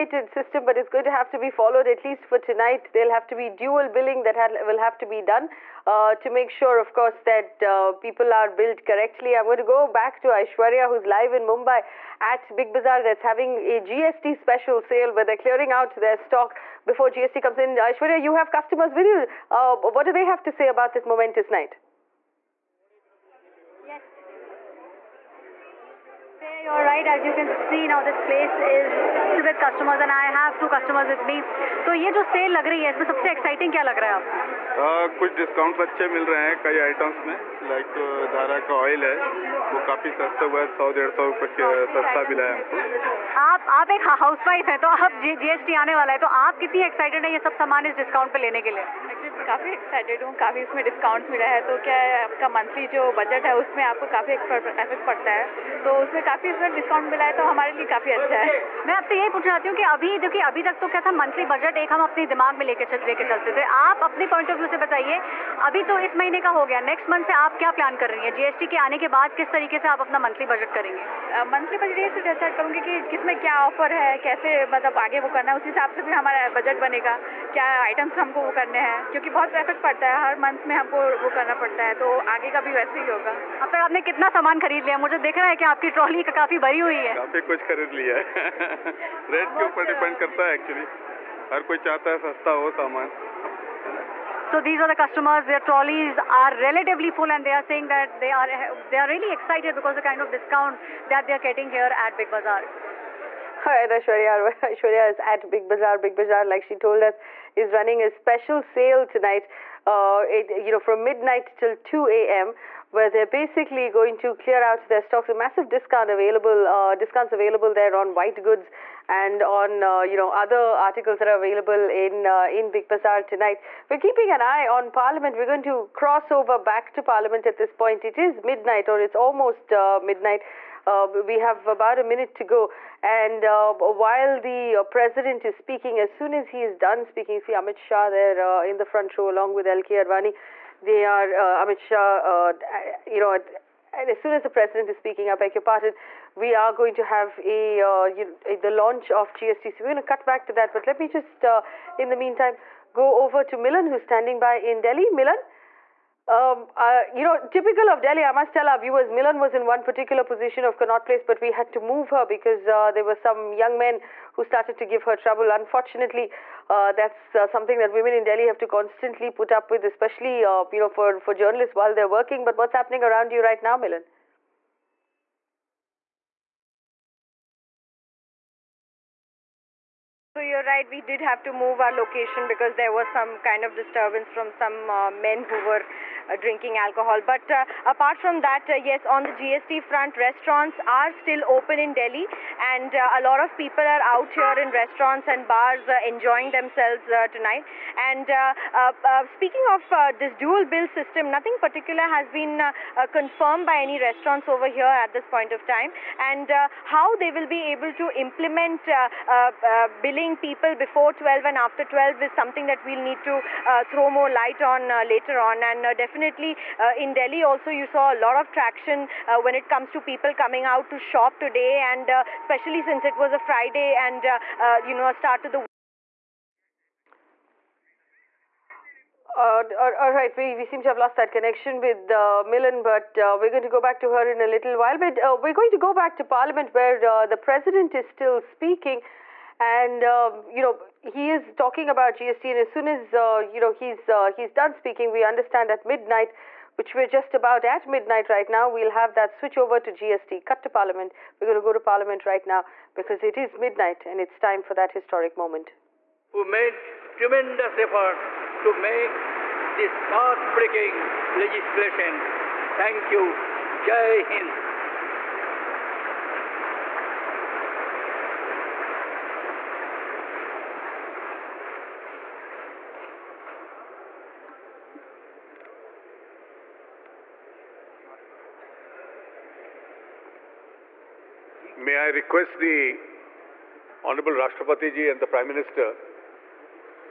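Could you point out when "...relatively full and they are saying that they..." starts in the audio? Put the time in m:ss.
1:36.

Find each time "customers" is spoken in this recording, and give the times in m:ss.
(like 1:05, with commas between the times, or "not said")
0:18, 1:34.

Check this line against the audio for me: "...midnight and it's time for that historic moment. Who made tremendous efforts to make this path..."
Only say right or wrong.
right.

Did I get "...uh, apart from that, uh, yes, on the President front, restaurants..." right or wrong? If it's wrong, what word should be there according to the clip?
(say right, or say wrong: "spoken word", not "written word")
wrong: "GST", not "President".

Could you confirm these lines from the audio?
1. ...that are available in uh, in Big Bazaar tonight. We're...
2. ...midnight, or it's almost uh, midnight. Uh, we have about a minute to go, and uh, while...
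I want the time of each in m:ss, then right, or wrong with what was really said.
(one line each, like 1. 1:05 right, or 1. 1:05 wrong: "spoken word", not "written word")
1. 2:01 right
2. 2:08 right.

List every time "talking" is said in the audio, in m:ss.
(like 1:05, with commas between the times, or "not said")
4:01.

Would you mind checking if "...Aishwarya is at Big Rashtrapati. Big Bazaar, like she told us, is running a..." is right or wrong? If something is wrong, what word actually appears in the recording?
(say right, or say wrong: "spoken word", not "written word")
wrong: "Bazaar", not "Rashtrapati".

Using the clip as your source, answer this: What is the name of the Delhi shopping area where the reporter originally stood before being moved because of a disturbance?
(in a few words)
Connaught Place.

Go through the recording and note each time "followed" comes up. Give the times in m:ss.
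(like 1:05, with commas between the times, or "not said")
0:01.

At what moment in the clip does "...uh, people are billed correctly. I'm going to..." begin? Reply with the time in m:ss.
0:07.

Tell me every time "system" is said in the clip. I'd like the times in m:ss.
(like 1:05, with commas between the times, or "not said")
0:00, 3:20.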